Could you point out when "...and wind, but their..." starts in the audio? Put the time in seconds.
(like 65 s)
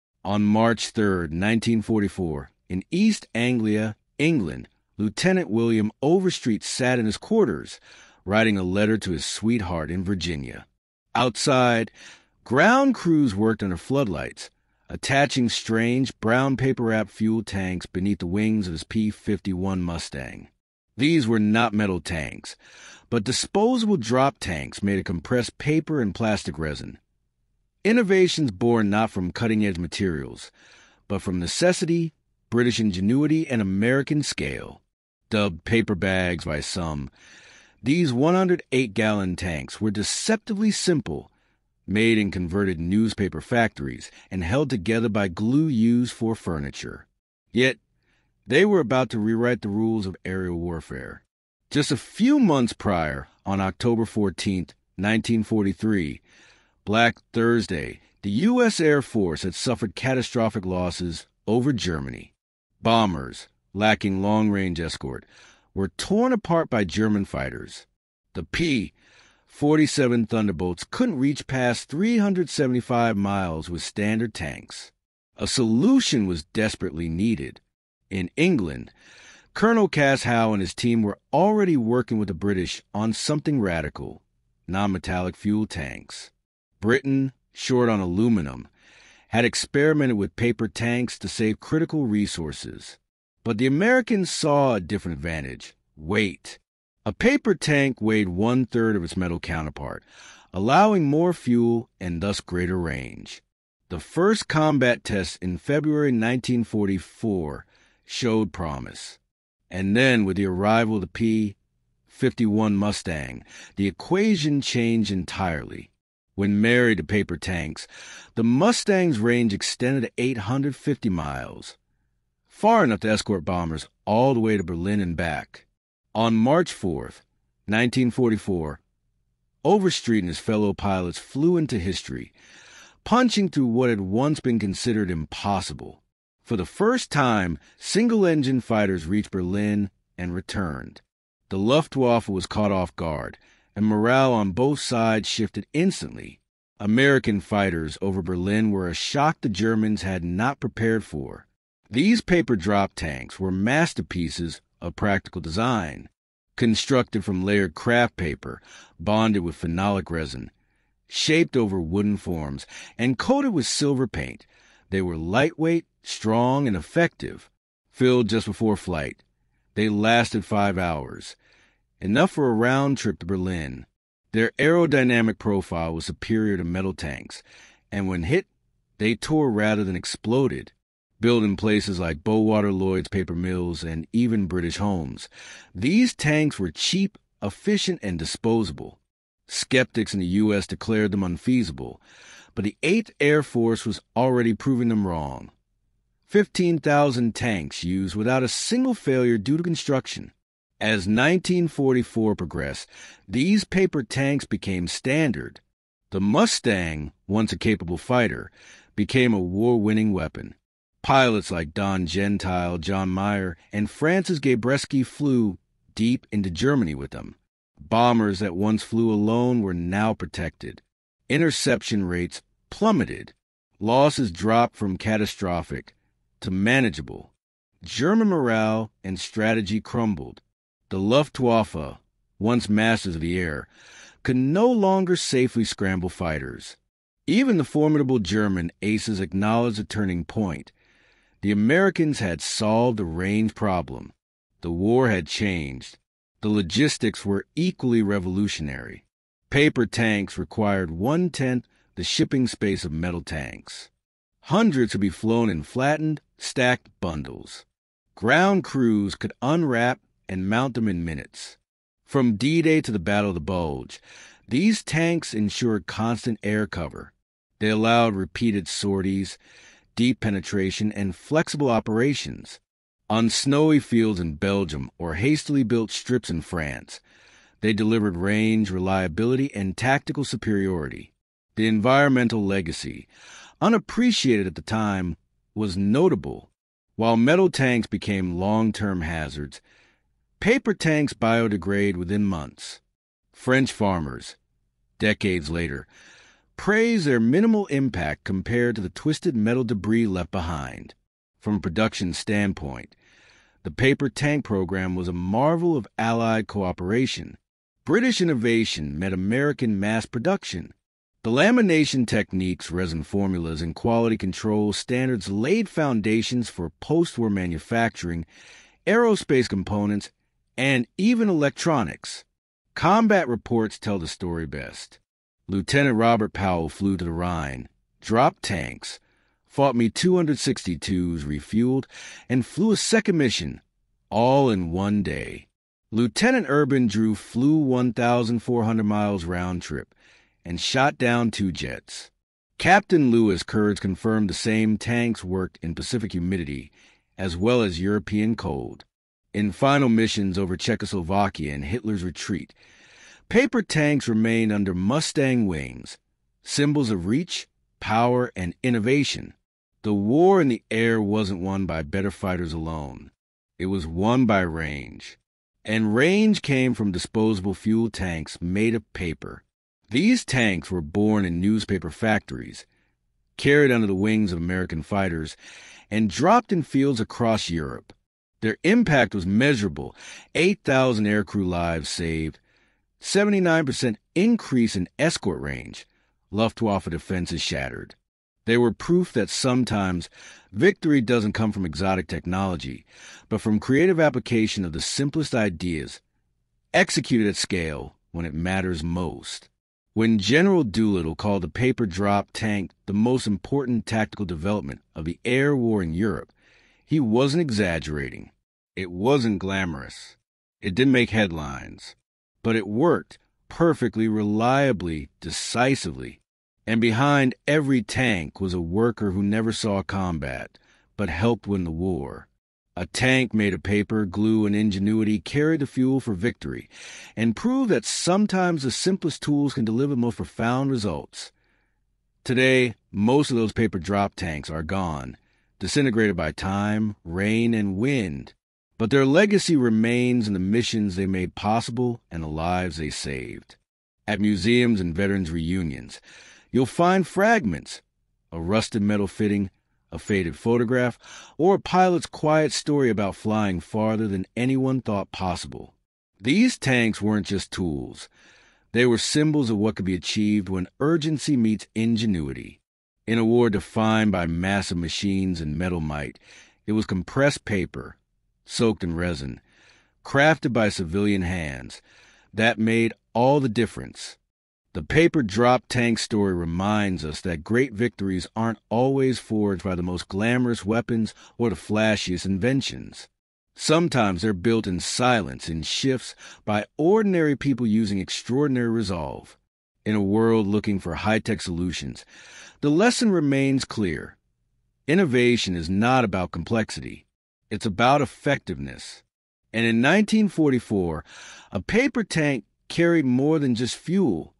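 437 s.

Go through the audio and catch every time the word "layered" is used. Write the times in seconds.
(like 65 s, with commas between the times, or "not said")
157 s.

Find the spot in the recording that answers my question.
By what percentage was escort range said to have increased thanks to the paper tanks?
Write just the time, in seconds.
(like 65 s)
382 s.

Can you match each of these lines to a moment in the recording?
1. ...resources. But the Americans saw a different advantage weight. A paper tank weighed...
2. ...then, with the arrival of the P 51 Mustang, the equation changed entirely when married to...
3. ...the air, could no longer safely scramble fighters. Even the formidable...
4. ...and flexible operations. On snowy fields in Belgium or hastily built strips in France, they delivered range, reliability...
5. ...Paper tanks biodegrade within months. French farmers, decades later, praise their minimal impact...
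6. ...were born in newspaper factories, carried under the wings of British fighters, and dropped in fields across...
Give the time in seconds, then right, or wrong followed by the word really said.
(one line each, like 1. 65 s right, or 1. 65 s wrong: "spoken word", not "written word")
1. 92 s right
2. 109 s right
3. 233 s right
4. 270 s right
5. 290 s right
6. 370 s wrong: "American", not "British".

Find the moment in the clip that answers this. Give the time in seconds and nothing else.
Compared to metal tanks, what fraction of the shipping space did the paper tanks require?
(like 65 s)
250 s.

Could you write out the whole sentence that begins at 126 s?
On March 4, 1944, Overstreet and his fellow pilots flew into history, punching through what had once been considered impossible.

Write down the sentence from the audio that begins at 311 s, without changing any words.
The lamination techniques, resin formulas, and quality control standards laid foundations for post war manufacturing, aerospace components, and even electronics.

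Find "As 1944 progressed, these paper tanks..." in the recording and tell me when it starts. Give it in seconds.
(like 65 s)
200 s.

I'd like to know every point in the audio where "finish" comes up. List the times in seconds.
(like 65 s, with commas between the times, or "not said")
not said.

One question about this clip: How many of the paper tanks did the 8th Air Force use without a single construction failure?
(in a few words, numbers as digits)
15,000.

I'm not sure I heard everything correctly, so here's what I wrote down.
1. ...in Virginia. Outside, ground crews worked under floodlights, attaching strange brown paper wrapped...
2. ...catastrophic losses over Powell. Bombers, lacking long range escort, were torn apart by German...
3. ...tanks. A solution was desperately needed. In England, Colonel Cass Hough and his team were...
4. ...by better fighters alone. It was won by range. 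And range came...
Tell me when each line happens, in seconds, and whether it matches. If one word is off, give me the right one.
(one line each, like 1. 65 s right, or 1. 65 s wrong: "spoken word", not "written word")
1. 9 s right
2. 59 s wrong: "Germany", not "Powell"
3. 74 s right
4. 361 s right.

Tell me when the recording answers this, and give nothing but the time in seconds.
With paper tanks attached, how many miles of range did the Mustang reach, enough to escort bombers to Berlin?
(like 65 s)
120 s.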